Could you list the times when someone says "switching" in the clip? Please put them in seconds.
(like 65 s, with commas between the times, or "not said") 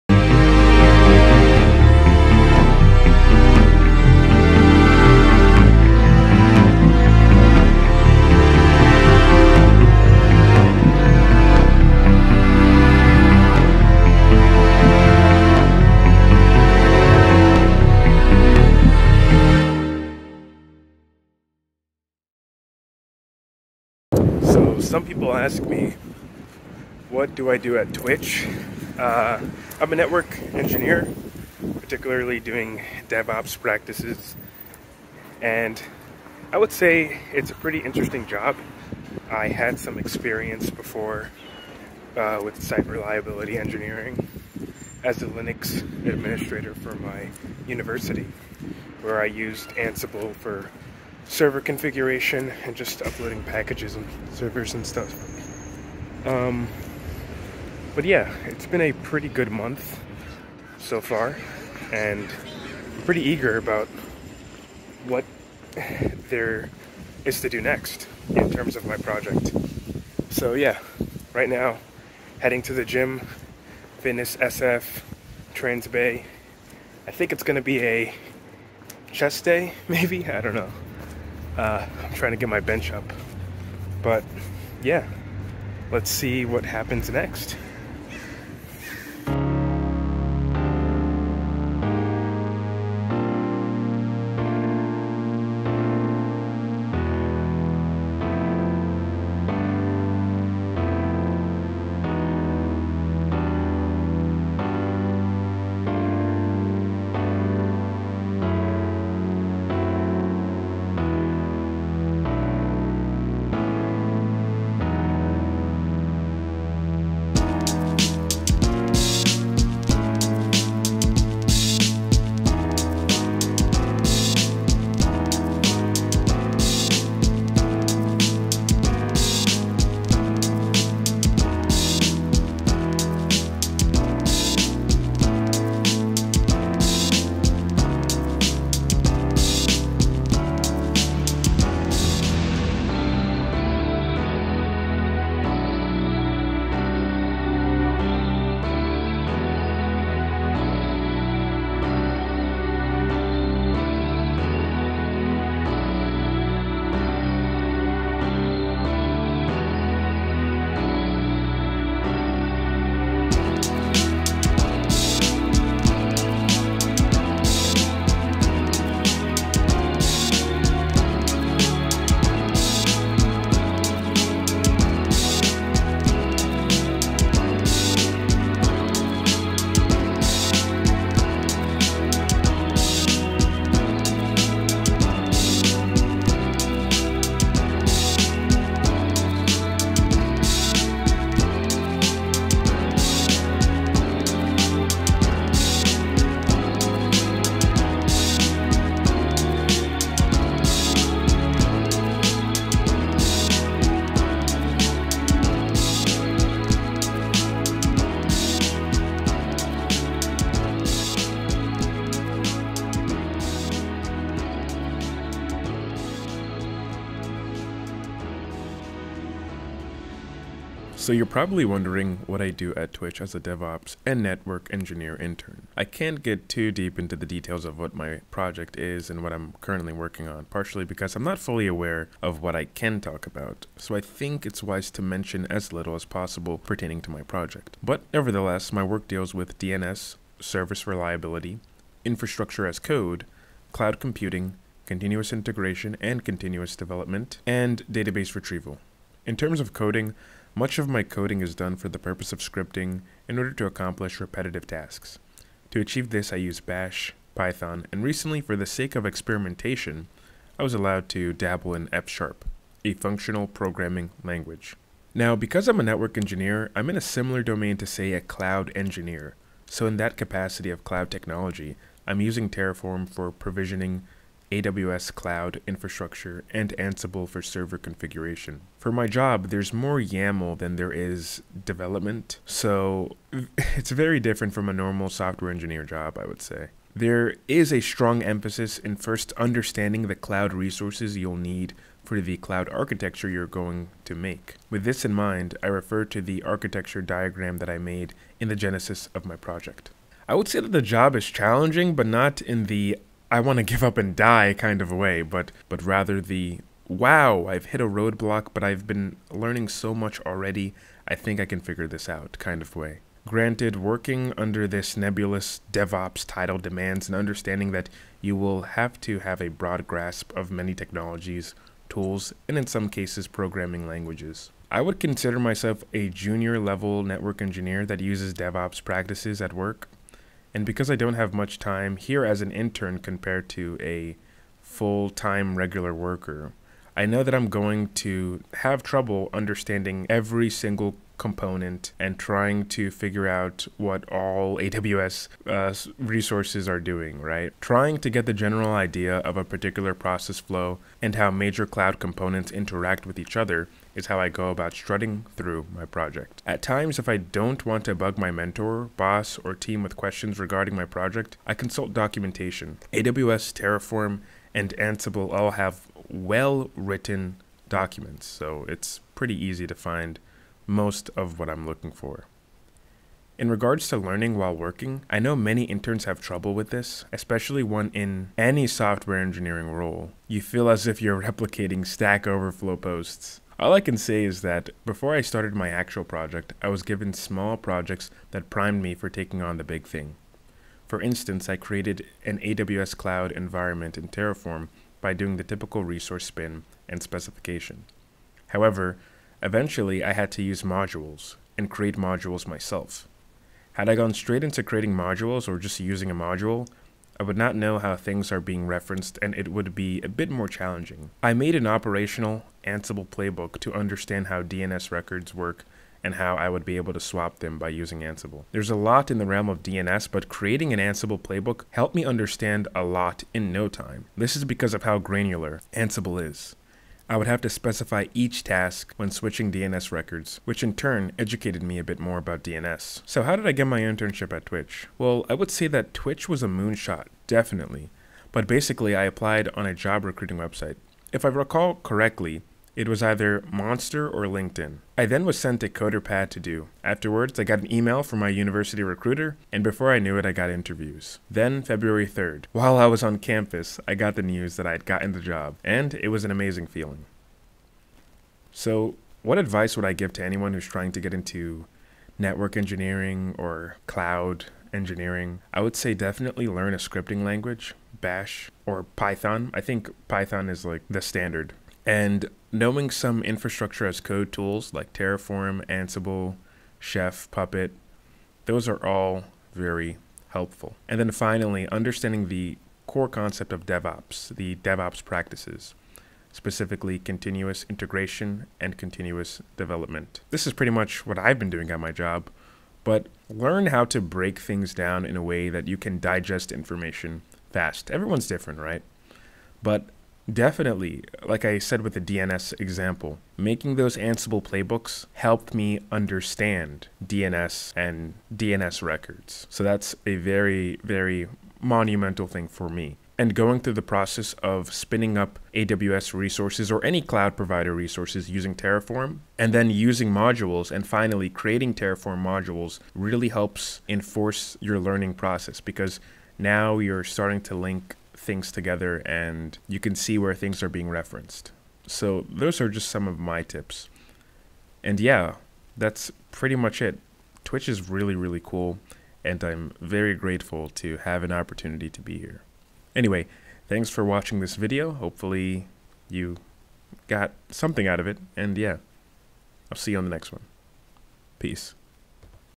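429 s.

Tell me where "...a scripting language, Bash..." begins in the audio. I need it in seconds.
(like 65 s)
466 s.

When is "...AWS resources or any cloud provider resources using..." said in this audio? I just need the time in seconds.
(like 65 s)
515 s.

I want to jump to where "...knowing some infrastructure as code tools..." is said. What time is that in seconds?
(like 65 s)
472 s.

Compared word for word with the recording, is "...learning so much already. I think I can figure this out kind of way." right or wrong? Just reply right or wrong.
right.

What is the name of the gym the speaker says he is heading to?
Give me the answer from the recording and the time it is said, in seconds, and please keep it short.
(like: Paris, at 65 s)
Fitness SF, at 73 s.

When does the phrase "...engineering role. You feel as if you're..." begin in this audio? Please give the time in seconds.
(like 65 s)
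379 s.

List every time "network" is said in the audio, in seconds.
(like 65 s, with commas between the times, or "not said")
29 s, 224 s, 265 s, 327 s, 462 s.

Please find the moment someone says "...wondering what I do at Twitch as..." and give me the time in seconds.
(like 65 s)
221 s.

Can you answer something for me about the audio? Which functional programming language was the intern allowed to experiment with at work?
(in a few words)
F#.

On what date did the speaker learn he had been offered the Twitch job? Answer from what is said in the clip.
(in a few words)
February 3rd.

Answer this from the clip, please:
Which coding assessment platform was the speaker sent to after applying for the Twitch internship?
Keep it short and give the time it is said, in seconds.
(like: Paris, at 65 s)
CoderPad, at 445 s.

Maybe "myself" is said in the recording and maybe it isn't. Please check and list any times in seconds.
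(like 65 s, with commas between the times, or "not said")
325 s, 402 s.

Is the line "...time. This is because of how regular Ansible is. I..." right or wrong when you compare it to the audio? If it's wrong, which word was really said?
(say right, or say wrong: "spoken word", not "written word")
wrong: "granular", not "regular".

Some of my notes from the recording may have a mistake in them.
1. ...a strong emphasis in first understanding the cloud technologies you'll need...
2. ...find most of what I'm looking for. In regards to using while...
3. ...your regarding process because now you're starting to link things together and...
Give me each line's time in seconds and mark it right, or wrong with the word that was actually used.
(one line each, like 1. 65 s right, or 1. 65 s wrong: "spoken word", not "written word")
1. 287 s wrong: "resources", not "technologies"
2. 369 s wrong: "learning", not "using"
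3. 524 s wrong: "learning", not "regarding".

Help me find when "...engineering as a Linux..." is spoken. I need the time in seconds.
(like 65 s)
43 s.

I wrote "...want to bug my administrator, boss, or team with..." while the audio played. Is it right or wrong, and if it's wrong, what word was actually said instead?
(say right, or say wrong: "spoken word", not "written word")
wrong: "mentor", not "administrator".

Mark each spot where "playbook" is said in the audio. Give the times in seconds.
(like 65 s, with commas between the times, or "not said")
413 s, 421 s, 504 s.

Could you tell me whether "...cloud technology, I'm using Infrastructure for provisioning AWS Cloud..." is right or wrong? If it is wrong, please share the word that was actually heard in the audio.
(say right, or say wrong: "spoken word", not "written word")
wrong: "Terraform", not "Infrastructure".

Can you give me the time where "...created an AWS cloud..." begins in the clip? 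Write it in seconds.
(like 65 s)
391 s.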